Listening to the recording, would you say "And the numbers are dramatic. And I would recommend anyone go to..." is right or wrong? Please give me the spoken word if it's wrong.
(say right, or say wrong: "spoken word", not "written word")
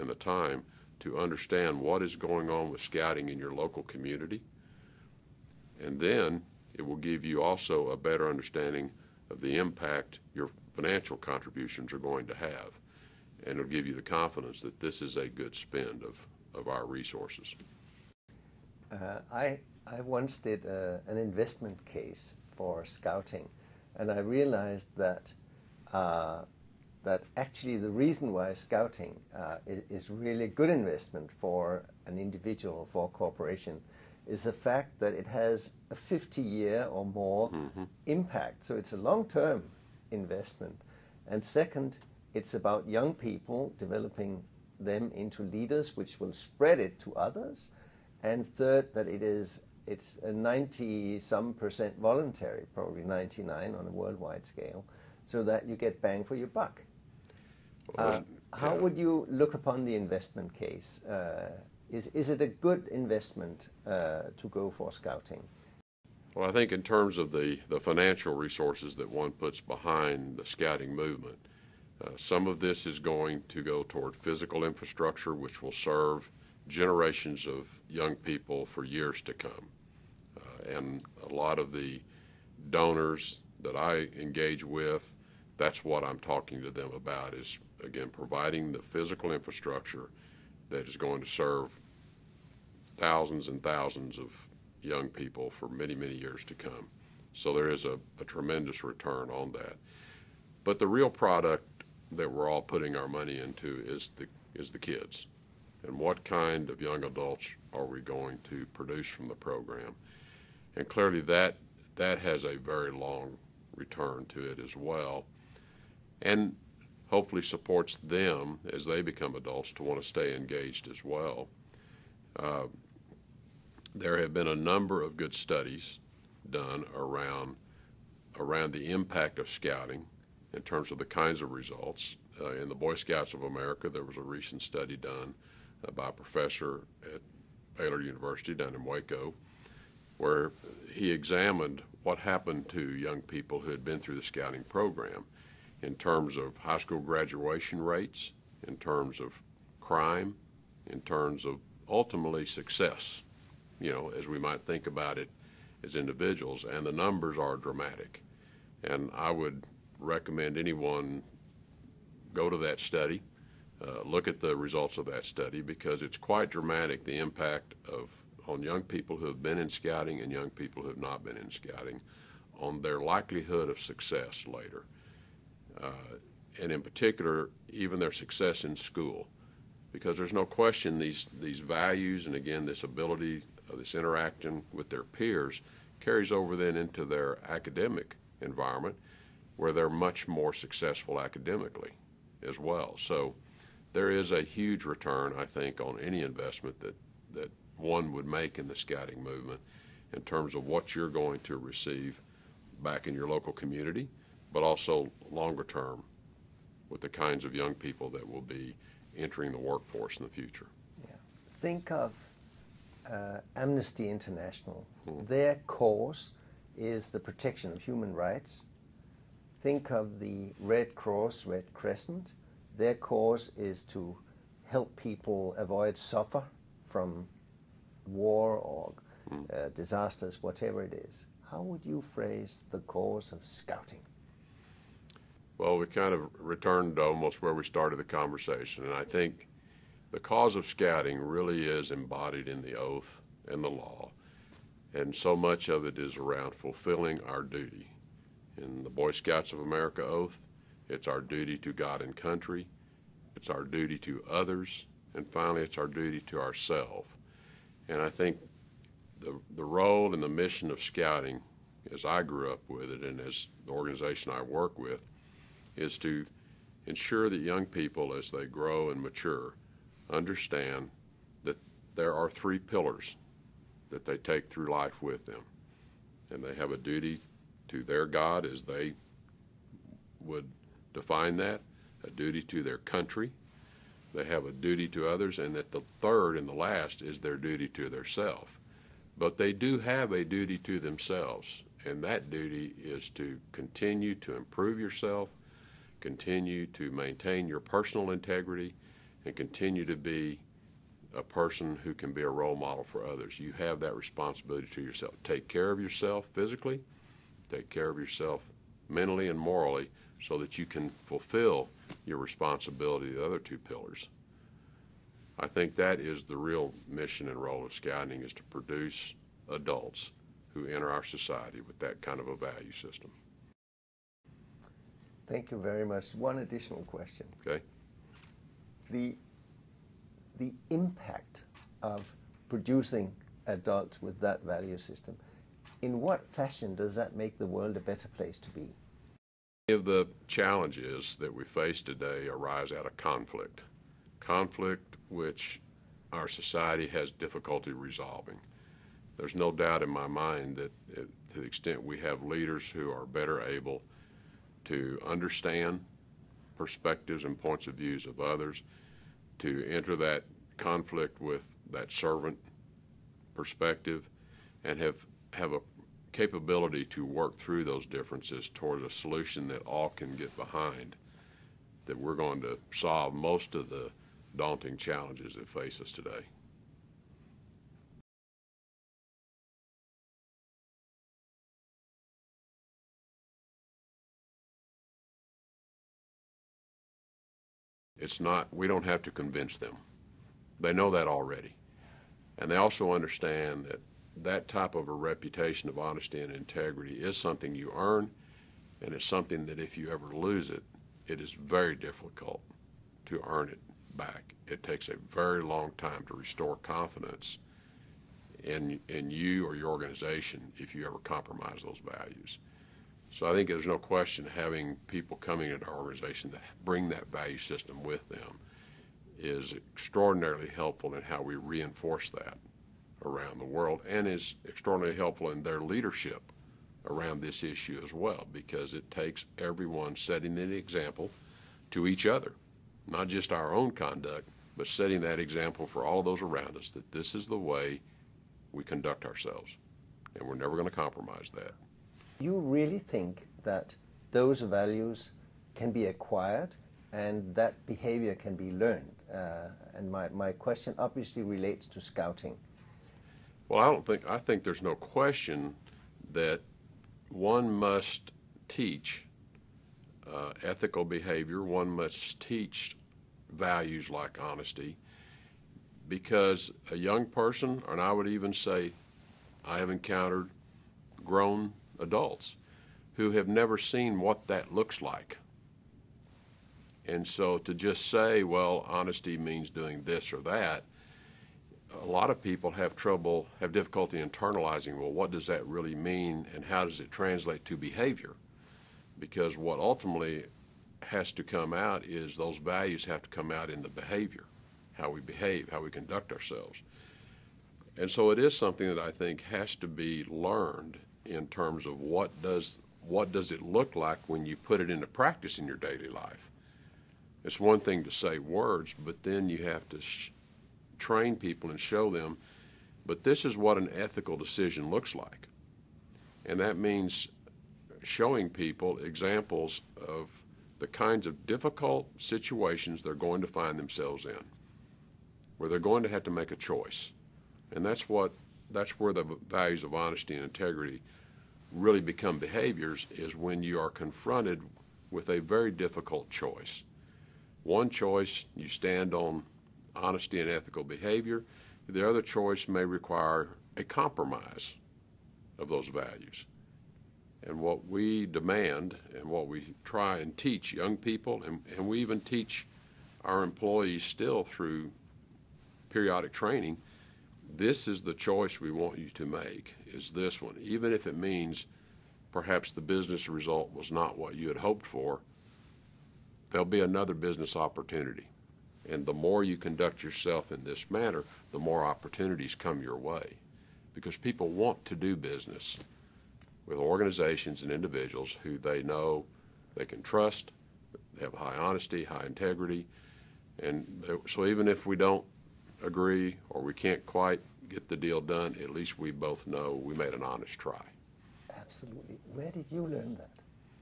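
right.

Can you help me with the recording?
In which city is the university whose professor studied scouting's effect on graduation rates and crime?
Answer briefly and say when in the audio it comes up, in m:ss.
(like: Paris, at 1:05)
Waco, at 2:18.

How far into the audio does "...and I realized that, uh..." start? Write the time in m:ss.
0:23.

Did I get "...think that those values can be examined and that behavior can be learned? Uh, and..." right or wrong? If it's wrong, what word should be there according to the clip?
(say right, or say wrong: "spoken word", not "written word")
wrong: "acquired", not "examined".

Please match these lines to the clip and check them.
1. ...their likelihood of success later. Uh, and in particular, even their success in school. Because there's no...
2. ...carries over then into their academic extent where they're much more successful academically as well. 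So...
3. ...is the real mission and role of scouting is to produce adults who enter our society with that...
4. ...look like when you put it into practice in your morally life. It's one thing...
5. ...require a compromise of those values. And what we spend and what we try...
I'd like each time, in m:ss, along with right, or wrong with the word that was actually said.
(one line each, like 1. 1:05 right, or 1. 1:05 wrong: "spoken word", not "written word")
1. 2:52 right
2. 3:05 wrong: "environment", not "extent"
3. 5:15 right
4. 8:23 wrong: "daily", not "morally"
5. 9:02 wrong: "demand", not "spend".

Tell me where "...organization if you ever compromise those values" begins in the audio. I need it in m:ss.
6:49.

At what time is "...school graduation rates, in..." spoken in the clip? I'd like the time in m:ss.
2:26.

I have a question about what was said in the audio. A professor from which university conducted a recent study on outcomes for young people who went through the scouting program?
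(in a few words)
Baylor University.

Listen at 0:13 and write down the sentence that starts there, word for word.
And it'll give you the confidence that this is a good spend of, of our resources.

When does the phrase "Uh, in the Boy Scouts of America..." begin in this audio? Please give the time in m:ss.
2:12.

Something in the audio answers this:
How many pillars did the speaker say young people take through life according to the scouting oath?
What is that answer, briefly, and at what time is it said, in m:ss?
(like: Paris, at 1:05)
3, at 4:32.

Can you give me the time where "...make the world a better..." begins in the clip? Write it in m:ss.
5:37.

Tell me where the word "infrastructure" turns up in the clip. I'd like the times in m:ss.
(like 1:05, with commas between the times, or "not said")
1:14, 1:29.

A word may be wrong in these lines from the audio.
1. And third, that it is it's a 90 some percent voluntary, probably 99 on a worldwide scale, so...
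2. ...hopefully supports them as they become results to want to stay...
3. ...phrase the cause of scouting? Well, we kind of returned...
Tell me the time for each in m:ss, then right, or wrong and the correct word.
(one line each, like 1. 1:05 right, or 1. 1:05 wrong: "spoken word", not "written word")
1. 0:48 right
2. 1:57 wrong: "adults", not "results"
3. 3:52 right.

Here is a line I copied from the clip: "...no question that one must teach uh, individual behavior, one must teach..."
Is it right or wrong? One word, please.
wrong.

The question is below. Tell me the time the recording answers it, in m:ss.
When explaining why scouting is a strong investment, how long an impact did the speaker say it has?
0:35.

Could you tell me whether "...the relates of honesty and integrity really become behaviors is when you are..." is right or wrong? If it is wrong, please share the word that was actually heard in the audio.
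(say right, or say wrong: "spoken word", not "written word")
wrong: "values", not "relates".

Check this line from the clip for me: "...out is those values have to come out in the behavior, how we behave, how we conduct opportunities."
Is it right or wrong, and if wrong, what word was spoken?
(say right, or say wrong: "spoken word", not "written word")
wrong: "ourselves", not "opportunities".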